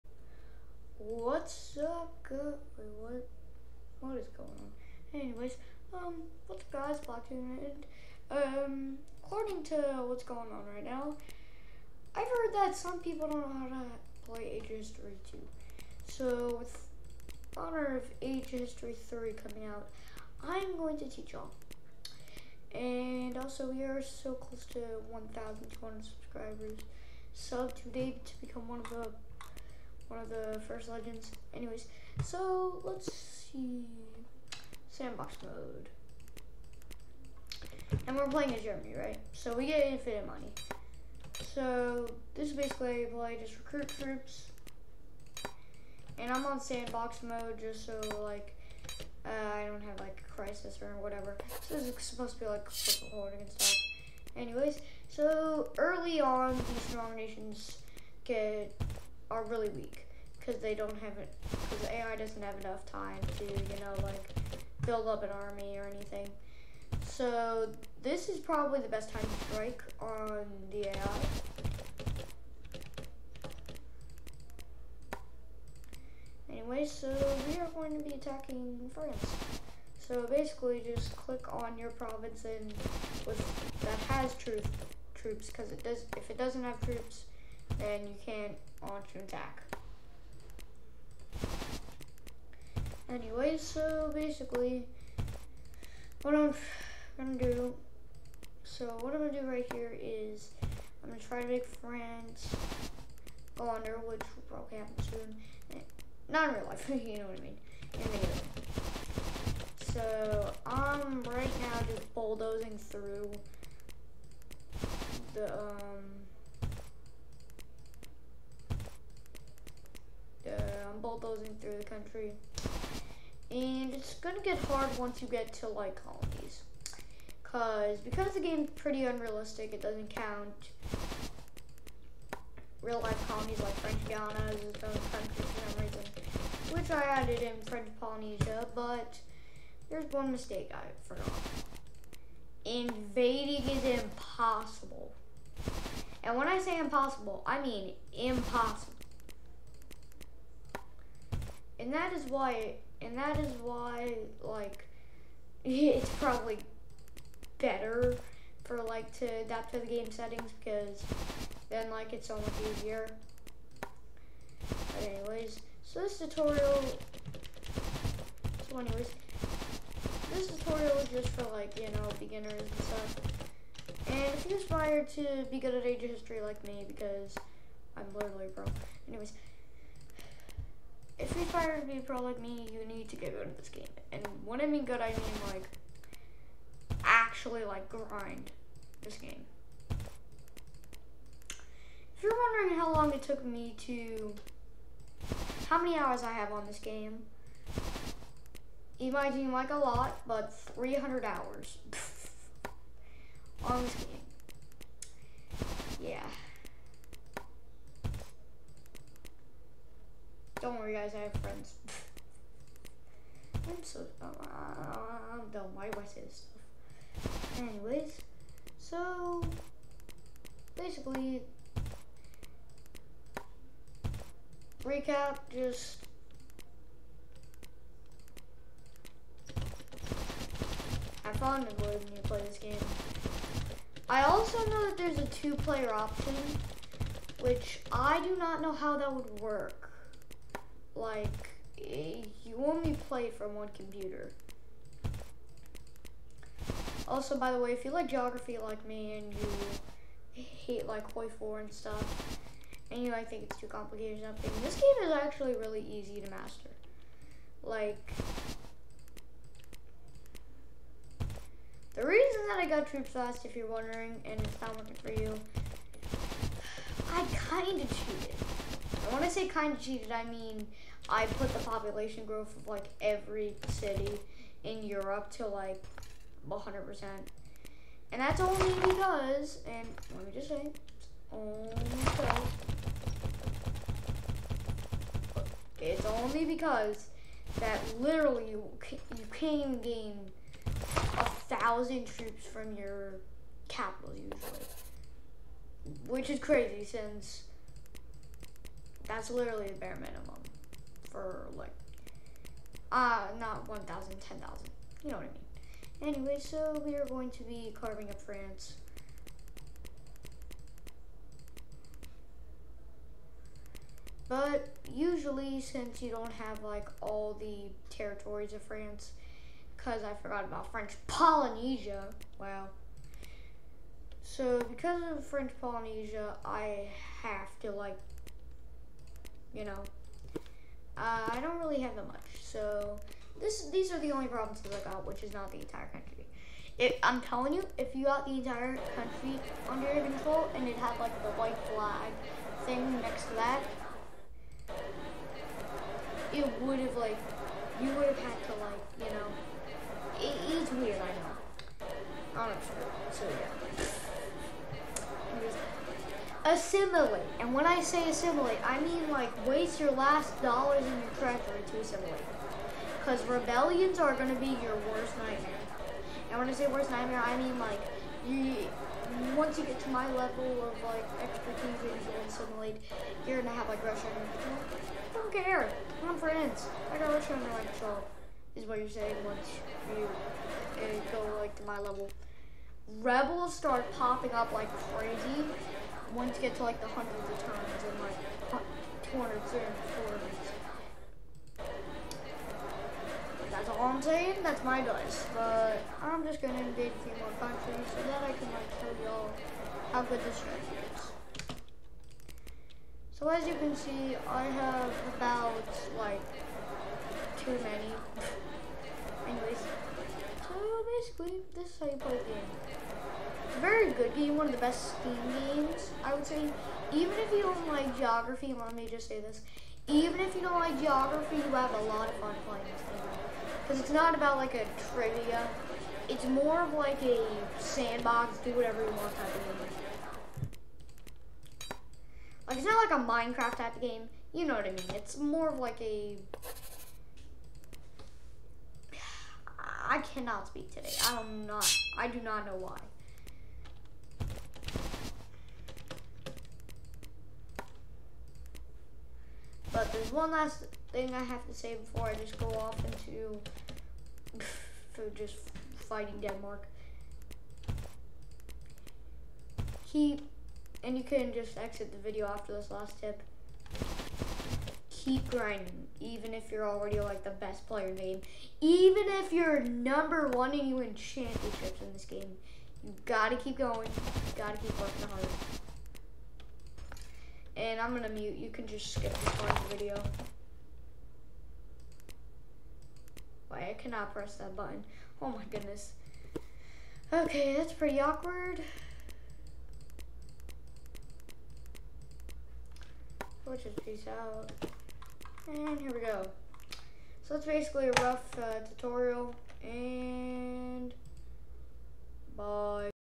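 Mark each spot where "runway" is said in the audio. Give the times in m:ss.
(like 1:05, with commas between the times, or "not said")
not said.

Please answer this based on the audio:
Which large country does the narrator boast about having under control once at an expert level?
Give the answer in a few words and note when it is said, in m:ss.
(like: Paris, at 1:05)
Russia, at 6:17.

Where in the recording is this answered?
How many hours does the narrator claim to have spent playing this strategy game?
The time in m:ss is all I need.
3:20.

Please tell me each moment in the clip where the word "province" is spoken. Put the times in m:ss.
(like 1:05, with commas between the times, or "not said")
1:21, 5:34.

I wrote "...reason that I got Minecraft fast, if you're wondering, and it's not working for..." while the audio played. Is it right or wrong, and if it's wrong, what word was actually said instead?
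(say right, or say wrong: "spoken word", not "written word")
wrong: "Troops", not "Minecraft".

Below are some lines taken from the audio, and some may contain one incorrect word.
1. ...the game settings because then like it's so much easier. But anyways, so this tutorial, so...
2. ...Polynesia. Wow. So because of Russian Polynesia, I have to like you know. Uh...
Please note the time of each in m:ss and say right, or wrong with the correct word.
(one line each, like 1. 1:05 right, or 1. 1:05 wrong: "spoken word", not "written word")
1. 2:39 right
2. 5:21 wrong: "French", not "Russian".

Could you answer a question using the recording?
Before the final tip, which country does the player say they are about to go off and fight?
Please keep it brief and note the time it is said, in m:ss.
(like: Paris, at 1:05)
Denmark, at 7:36.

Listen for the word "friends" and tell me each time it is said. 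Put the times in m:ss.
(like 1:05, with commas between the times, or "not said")
3:31, 6:16.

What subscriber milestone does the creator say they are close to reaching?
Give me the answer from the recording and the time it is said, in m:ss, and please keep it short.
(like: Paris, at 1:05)
1,200, at 0:25.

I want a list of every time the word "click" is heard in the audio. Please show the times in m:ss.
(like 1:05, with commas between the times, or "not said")
1:21.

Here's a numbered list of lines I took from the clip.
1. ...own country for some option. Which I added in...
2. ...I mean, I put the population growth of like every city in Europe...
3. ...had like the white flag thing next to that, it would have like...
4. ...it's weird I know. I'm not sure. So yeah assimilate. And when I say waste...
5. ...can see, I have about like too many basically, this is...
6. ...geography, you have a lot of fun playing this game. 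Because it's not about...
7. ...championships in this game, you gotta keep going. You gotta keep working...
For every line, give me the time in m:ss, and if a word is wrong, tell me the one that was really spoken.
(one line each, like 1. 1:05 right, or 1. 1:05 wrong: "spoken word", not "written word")
1. 2:14 wrong: "reason", not "option"
2. 4:30 right
3. 5:40 right
4. 5:50 wrong: "assimilate", not "waste"
5. 6:43 right
6. 7:00 right
7. 7:50 right.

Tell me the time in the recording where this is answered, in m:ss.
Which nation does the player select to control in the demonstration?
0:38.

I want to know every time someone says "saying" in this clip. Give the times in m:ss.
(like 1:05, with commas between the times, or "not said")
6:18, 6:34.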